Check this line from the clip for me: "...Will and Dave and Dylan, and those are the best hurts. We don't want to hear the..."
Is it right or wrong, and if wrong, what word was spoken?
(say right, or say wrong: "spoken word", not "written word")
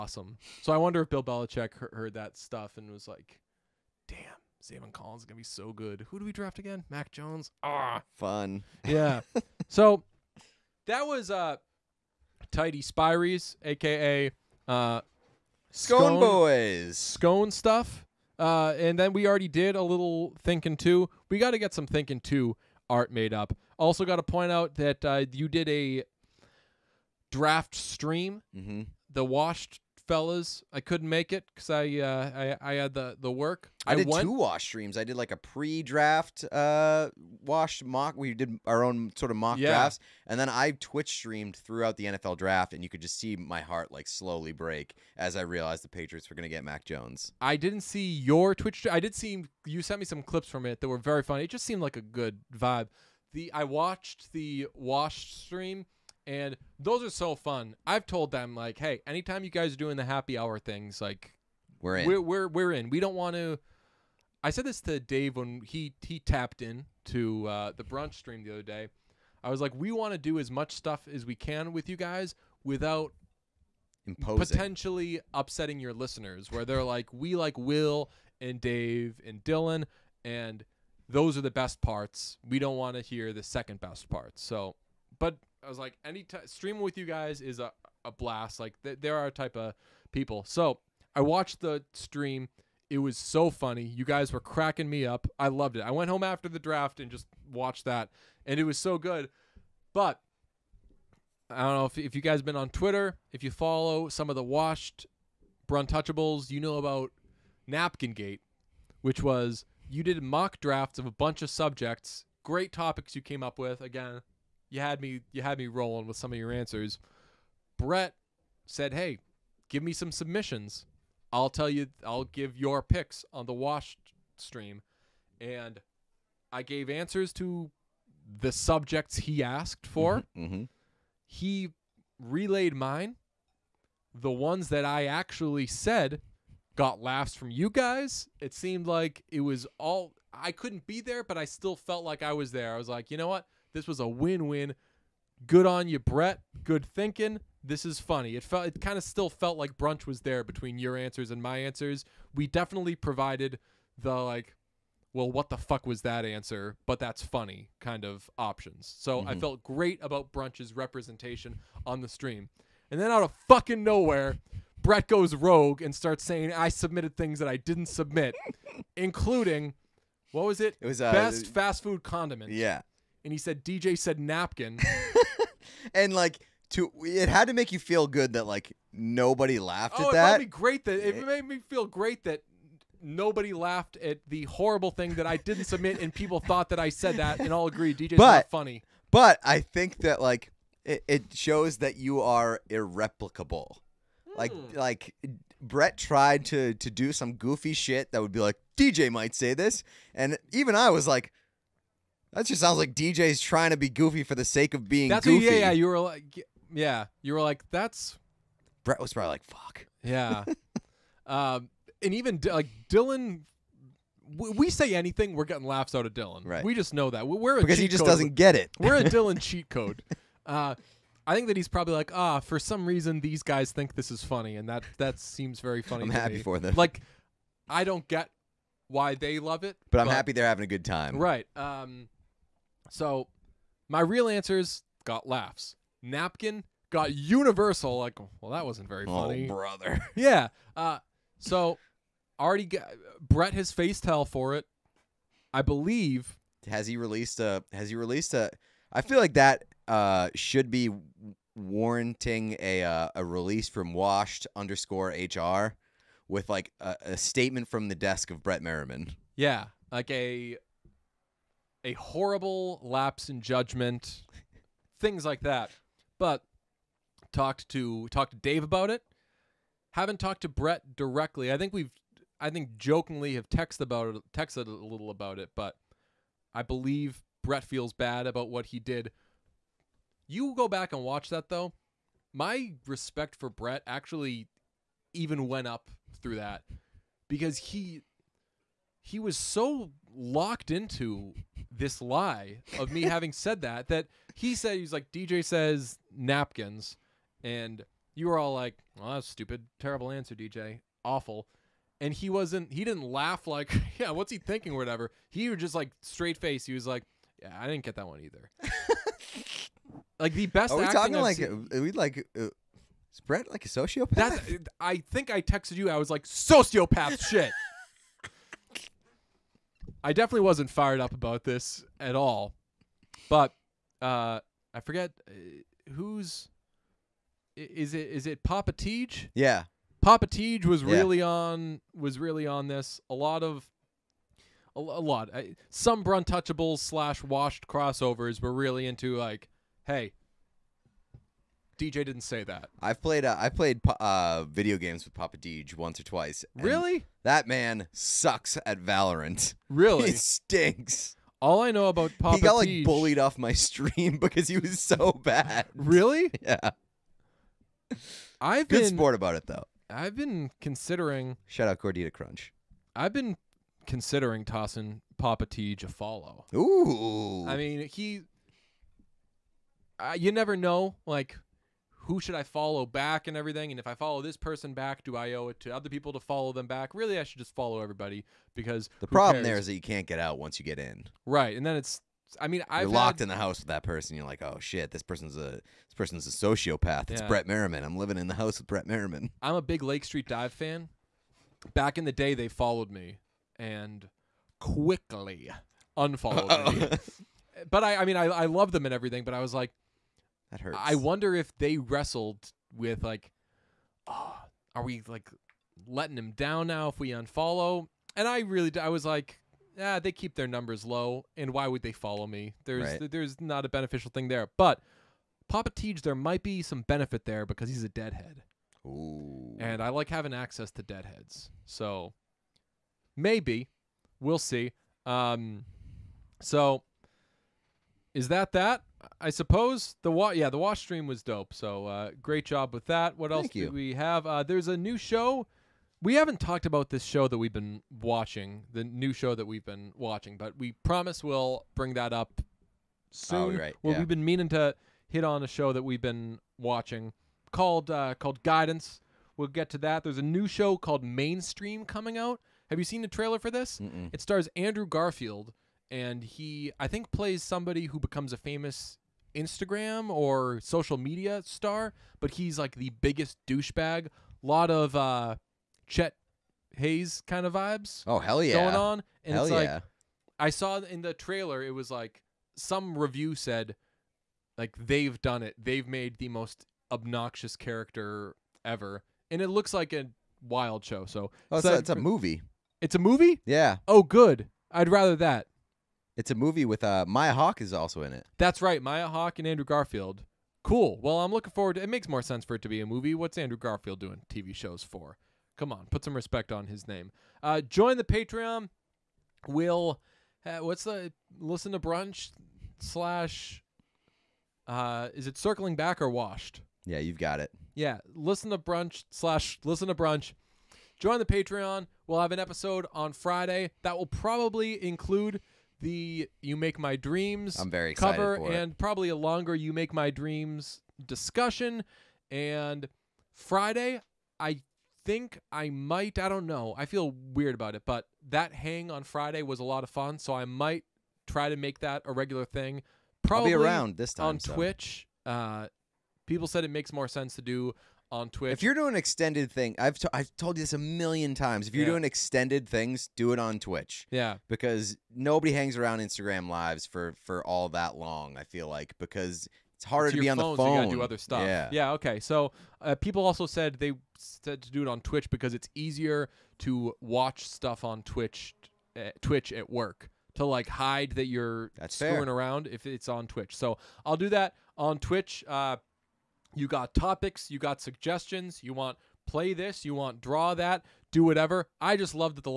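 wrong: "parts", not "hurts".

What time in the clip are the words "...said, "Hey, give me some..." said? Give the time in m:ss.
1:58.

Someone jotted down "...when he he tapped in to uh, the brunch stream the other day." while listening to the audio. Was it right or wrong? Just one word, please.
right.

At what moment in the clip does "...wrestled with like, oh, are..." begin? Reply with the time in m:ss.
6:41.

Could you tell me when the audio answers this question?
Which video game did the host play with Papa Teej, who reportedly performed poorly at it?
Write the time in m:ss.
5:48.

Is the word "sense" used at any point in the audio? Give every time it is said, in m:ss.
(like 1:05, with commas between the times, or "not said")
8:12, 8:57.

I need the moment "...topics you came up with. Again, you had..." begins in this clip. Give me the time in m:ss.
1:52.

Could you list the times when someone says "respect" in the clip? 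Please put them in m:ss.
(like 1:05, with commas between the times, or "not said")
4:42, 8:16.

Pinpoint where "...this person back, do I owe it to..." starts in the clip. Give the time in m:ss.
6:14.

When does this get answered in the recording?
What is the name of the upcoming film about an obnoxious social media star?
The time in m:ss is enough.
7:31.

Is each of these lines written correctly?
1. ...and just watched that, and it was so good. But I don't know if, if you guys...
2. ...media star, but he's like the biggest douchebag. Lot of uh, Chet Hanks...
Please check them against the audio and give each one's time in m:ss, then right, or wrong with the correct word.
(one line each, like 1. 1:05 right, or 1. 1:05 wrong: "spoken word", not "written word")
1. 1:36 right
2. 7:40 right.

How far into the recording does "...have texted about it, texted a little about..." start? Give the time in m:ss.
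4:33.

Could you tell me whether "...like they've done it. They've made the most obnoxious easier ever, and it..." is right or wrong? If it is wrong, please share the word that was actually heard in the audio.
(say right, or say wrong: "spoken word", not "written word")
wrong: "character", not "easier".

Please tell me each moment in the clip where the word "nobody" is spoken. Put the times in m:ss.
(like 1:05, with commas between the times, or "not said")
2:58, 3:03, 9:05.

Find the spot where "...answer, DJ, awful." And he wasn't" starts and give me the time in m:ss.
5:00.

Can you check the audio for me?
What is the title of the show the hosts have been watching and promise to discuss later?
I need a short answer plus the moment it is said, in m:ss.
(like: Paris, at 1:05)
Guidance, at 7:28.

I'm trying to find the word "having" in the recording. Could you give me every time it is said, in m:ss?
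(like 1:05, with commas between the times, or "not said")
3:50, 4:53, 7:00.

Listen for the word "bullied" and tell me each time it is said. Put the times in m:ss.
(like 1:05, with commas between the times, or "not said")
5:52.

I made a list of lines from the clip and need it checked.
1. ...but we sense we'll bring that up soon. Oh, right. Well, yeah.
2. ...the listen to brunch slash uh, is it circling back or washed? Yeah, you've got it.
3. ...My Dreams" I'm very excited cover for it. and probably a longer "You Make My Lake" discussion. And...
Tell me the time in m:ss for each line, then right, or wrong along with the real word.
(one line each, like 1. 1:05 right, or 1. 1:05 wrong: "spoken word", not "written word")
1. 7:20 wrong: "promise", not "sense"
2. 8:20 right
3. 8:36 wrong: "Dreams", not "Lake".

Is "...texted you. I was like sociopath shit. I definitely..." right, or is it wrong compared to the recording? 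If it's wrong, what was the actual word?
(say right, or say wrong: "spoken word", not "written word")
right.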